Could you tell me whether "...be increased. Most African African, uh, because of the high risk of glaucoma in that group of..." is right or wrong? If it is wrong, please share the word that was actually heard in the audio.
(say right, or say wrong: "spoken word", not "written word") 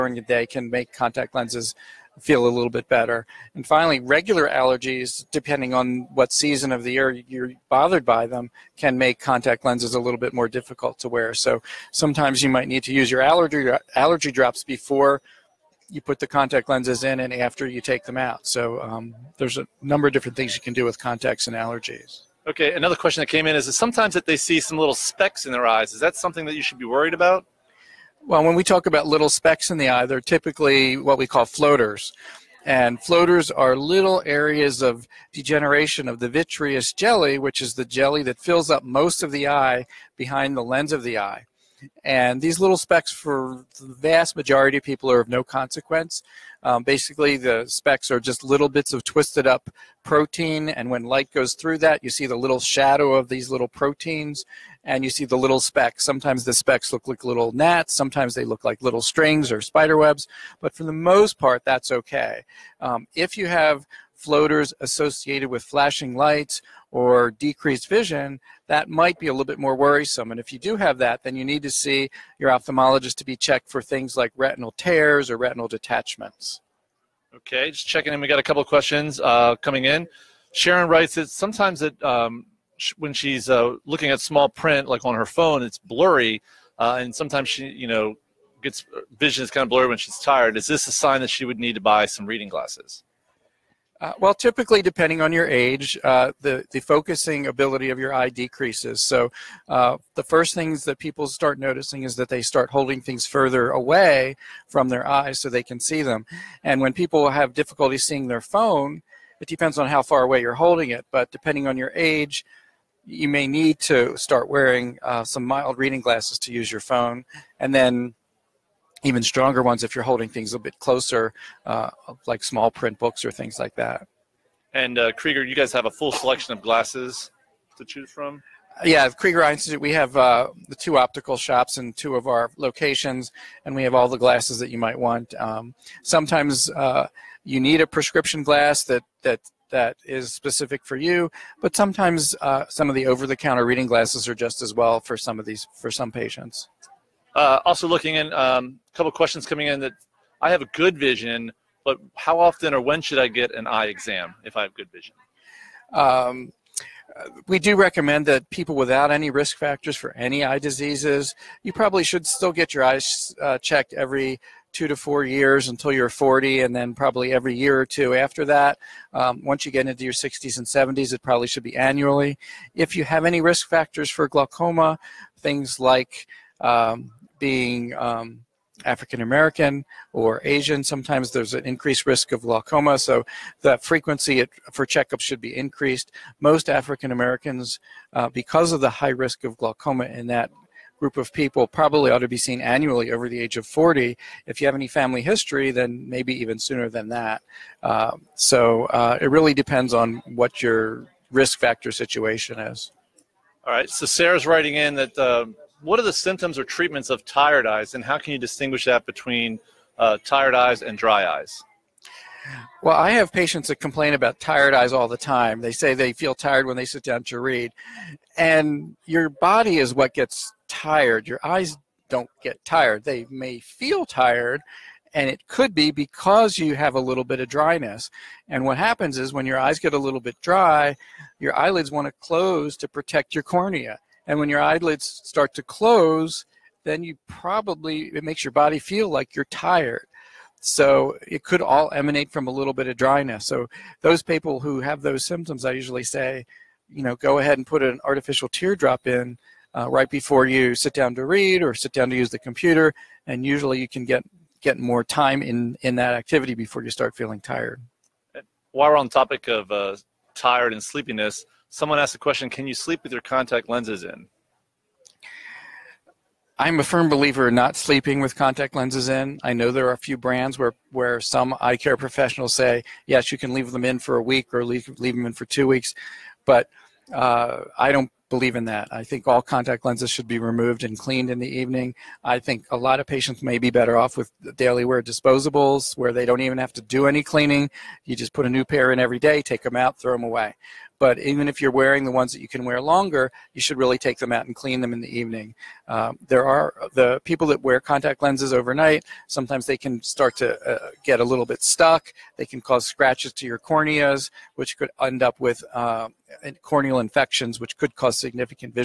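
wrong: "Americans", not "African".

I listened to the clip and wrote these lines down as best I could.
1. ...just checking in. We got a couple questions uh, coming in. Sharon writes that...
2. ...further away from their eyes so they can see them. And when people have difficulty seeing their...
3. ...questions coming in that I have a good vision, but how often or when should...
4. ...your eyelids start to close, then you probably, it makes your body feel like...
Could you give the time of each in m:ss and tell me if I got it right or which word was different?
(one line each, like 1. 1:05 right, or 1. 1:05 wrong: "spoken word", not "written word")
1. 1:17 right
2. 1:43 right
3. 2:29 right
4. 3:54 right.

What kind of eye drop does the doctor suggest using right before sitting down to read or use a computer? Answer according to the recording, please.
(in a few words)
artificial teardrop.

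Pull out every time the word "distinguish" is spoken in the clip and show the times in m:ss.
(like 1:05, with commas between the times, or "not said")
3:28.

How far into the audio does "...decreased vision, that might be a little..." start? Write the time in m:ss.
1:07.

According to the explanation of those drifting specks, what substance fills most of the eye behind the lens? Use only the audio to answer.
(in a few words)
vitreous jelly.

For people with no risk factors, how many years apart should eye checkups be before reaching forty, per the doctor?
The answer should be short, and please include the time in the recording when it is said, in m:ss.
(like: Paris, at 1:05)
2 to 4 years, at 2:43.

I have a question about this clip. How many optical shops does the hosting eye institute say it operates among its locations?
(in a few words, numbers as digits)
2.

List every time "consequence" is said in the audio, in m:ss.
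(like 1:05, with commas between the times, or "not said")
0:45.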